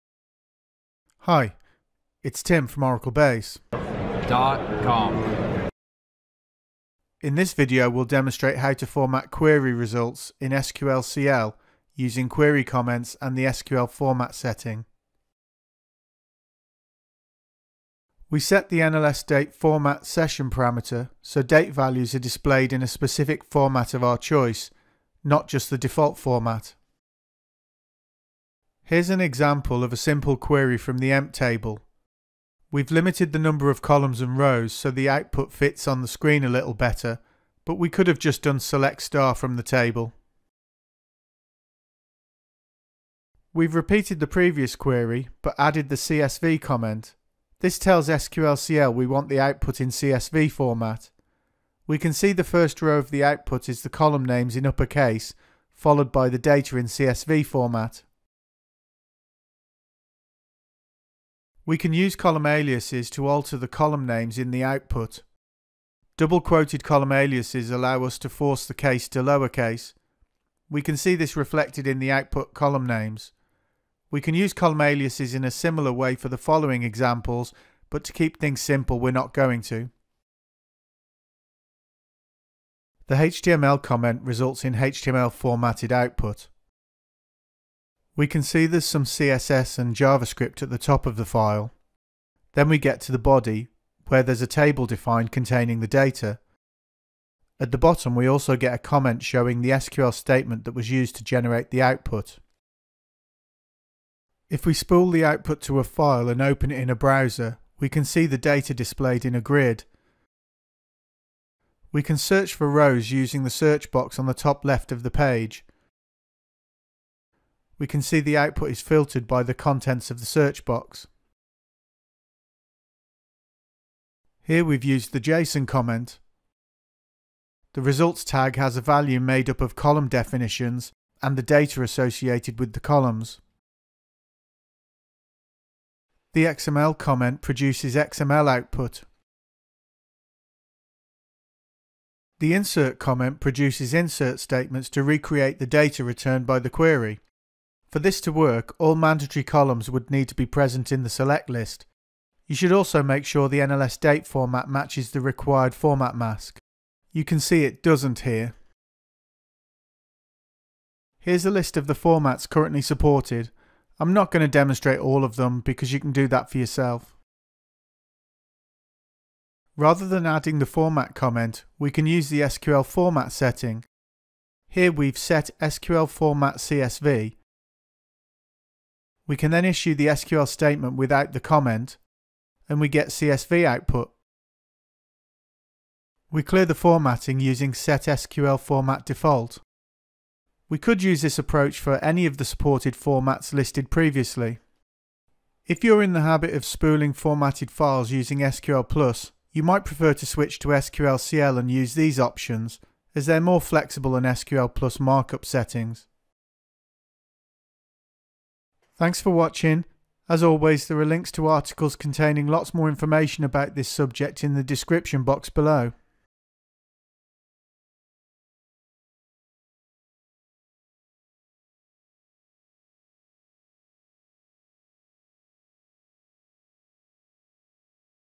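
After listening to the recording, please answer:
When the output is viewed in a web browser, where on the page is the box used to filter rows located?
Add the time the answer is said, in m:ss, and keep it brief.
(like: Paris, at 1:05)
top left, at 1:54.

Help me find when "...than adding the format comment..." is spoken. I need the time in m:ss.
2:50.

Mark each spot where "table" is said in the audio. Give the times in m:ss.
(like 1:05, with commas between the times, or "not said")
0:31, 0:39, 1:34.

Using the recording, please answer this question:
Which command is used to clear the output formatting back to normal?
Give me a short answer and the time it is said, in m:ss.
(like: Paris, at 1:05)
SET SQL format default, at 3:07.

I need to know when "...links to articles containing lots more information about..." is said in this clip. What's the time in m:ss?
3:31.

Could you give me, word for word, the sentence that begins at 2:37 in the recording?
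You can see it doesn't here.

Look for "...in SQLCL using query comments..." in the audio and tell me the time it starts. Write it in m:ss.
0:10.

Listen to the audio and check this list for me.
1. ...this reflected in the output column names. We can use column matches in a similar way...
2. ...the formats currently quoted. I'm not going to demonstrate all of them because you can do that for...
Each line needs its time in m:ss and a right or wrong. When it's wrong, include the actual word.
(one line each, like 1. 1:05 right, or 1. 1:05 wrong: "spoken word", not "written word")
1. 1:11 wrong: "aliases", not "matches"
2. 2:41 wrong: "supported", not "quoted".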